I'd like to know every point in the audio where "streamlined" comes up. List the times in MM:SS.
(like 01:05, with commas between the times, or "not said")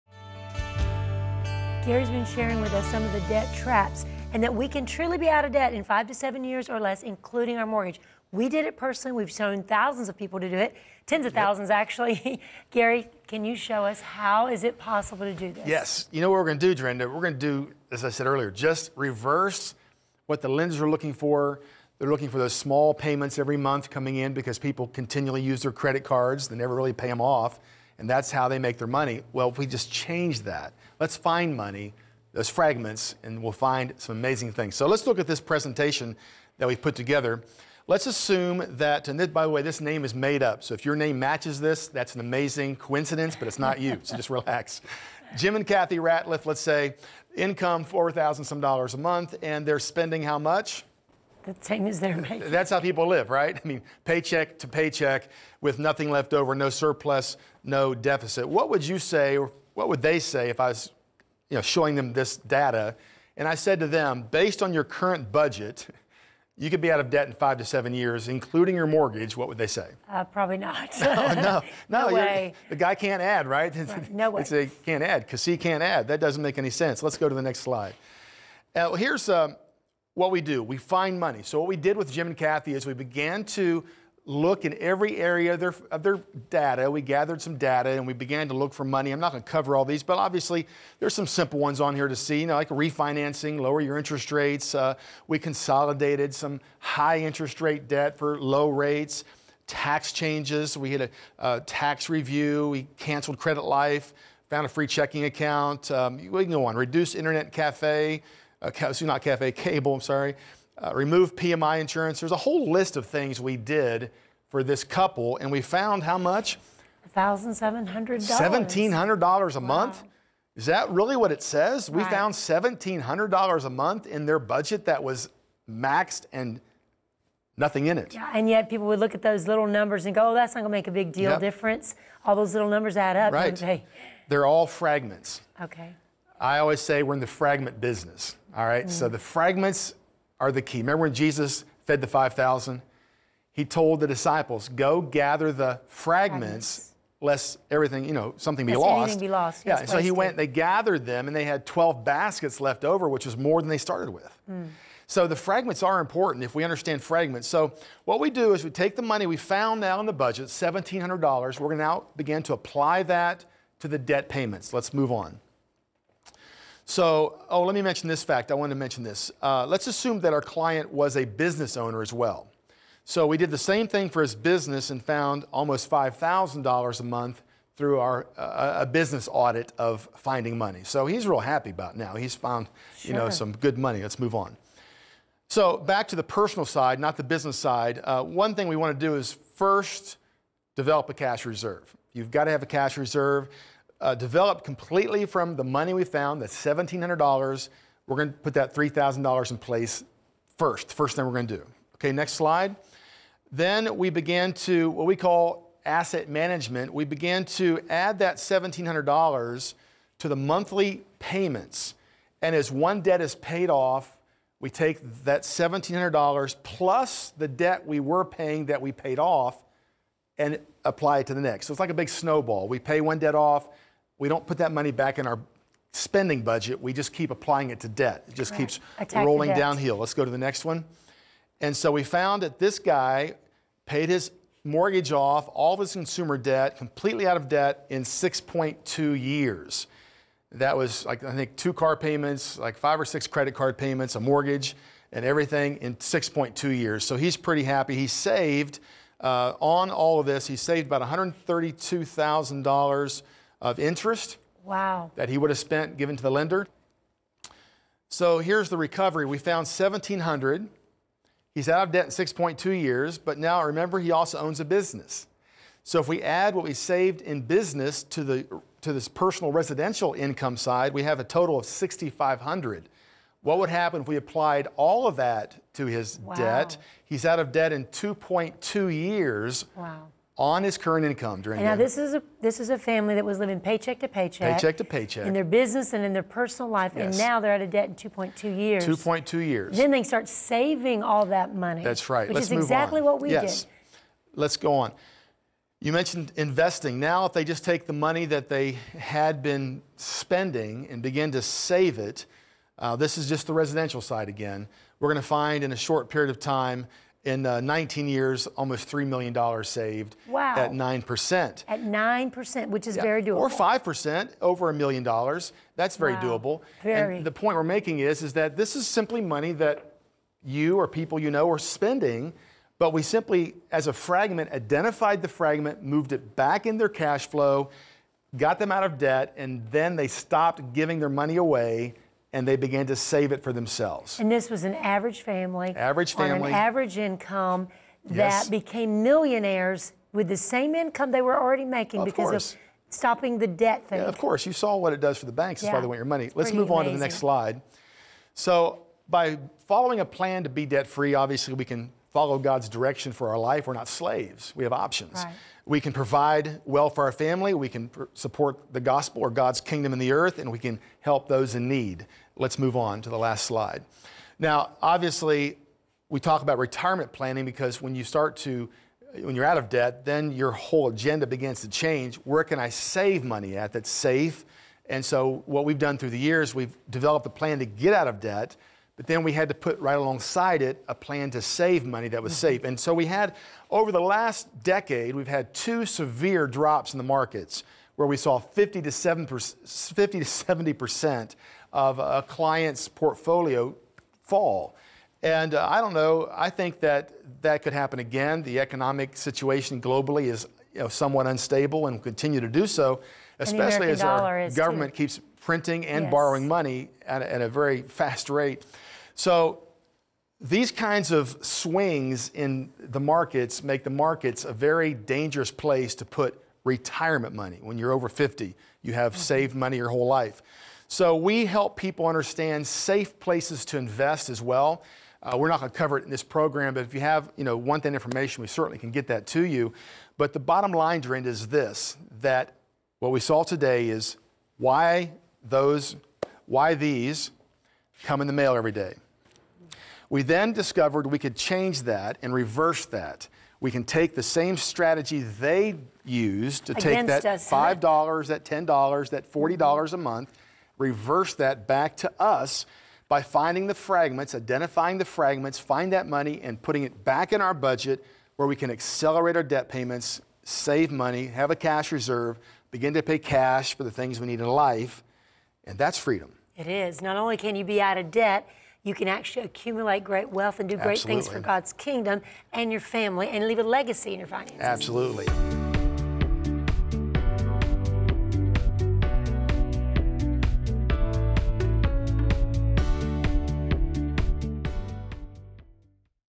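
not said.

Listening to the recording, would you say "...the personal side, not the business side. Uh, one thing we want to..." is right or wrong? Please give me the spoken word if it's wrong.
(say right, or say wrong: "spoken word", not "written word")
right.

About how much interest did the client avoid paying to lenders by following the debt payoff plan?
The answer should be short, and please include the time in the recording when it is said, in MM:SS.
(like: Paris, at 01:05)
$132,000, at 04:11.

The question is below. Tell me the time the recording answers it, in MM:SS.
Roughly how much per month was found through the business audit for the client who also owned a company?
02:55.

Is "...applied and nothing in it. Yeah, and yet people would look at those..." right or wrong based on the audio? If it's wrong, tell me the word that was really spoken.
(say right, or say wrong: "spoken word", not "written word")
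wrong: "maxed", not "applied".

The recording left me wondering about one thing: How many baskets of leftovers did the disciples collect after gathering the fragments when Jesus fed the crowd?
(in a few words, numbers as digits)
12.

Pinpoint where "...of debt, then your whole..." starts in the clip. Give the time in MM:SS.
06:09.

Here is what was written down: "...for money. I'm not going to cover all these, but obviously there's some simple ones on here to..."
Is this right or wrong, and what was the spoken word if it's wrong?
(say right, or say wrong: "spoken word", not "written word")
right.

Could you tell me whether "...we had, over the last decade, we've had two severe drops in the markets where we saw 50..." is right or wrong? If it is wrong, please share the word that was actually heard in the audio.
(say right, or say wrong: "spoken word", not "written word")
right.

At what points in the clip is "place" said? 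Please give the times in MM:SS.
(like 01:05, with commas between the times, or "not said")
03:19, 06:55, 07:03.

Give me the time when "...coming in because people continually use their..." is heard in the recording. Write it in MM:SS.
00:23.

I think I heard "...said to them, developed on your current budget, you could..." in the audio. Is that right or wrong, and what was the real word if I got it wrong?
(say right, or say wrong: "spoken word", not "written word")
wrong: "based", not "developed".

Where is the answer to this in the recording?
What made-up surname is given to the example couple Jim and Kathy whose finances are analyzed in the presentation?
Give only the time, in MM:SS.
00:45.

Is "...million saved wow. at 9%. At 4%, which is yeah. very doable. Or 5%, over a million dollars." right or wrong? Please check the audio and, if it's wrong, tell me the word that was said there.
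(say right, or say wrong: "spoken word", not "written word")
wrong: "9", not "4".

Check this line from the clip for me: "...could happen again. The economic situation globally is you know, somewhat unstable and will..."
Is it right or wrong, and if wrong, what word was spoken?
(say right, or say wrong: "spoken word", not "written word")
right.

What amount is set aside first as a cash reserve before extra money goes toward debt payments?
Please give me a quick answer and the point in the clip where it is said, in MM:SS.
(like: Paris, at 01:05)
$3,000, at 03:18.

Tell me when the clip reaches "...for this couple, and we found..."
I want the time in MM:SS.
01:54.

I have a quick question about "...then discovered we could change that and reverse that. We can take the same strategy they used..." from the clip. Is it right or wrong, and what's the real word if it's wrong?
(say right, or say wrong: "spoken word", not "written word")
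right.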